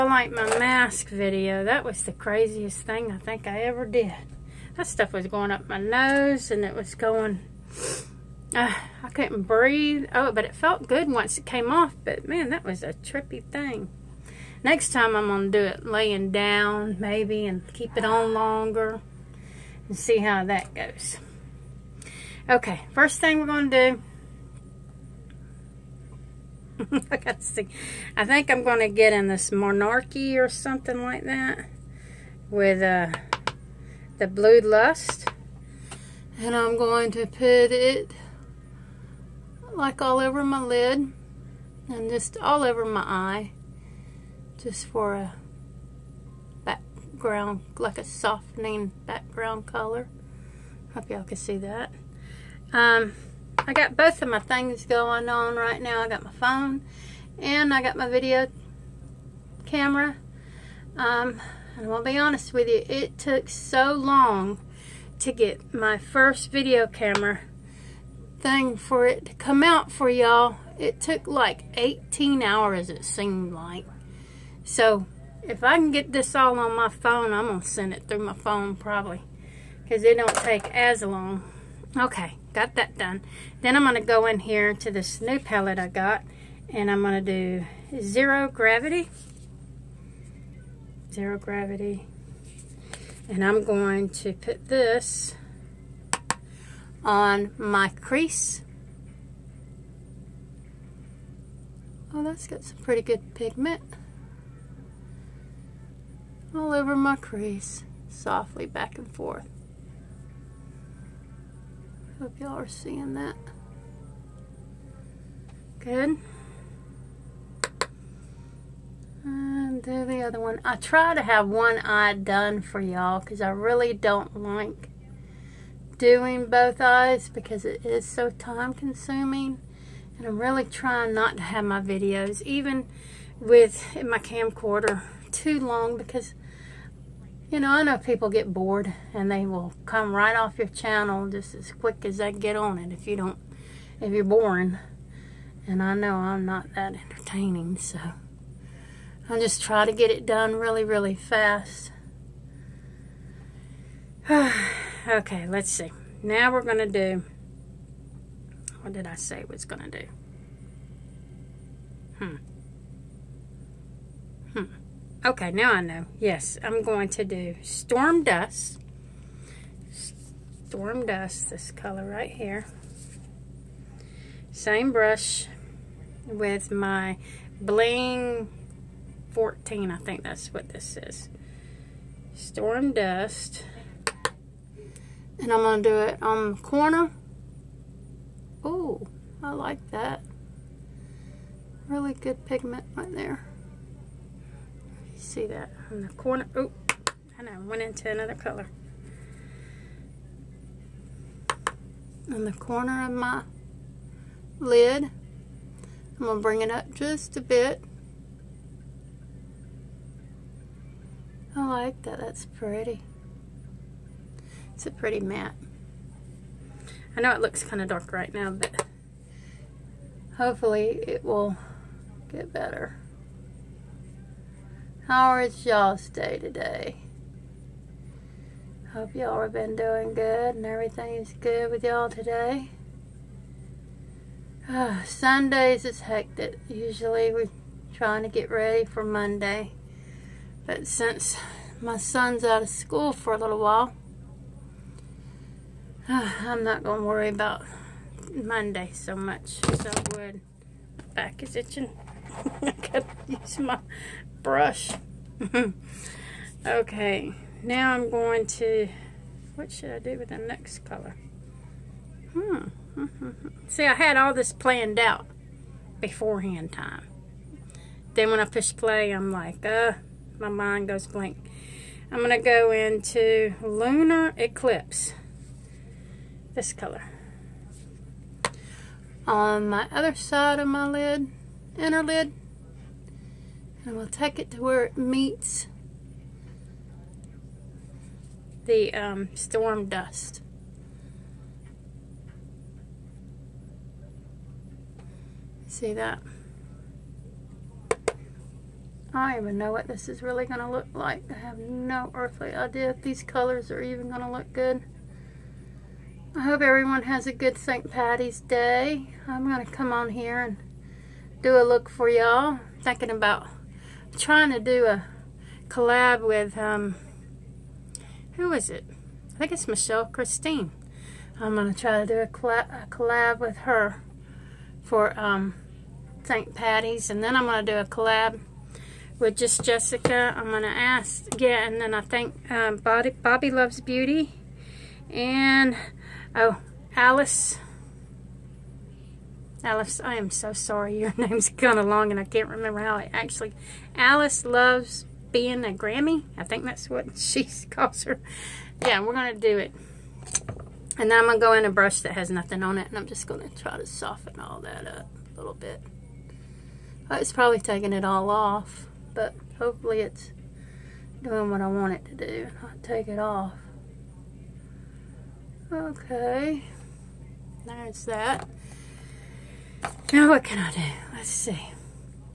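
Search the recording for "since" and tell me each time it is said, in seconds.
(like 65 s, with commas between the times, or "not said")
240 s.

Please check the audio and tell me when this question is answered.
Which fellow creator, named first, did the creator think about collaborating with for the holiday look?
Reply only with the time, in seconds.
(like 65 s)
319 s.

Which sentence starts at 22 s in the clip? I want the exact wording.
Okay, first thing we're going to do.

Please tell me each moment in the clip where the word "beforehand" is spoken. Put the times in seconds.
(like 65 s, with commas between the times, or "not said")
265 s.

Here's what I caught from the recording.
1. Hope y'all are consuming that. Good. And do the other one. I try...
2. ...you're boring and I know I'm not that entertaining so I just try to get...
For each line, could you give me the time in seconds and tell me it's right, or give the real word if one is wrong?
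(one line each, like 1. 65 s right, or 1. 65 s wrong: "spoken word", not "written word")
1. 112 s wrong: "seeing", not "consuming"
2. 144 s right.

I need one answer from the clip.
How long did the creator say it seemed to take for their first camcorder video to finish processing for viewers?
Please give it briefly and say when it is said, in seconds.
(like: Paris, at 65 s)
18 hours, at 71 s.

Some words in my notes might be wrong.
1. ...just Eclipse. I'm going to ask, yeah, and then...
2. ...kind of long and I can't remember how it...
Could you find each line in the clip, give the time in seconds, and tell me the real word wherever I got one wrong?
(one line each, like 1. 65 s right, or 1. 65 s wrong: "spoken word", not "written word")
1. 329 s wrong: "Jessica", not "Eclipse"
2. 341 s right.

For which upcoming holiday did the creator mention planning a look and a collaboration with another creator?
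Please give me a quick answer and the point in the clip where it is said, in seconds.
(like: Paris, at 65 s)
St. Patty's Day, at 307 s.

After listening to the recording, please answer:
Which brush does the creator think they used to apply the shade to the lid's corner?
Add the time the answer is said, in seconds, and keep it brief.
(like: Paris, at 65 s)
Bling 14, at 177 s.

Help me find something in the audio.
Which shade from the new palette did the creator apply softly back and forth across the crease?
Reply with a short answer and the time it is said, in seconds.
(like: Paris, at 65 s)
Zero Gravity, at 91 s.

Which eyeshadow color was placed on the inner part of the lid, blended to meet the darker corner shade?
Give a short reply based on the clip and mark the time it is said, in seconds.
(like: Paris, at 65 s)
Lunar Eclipse, at 273 s.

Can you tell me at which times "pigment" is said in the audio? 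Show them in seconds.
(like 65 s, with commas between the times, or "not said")
103 s, 192 s.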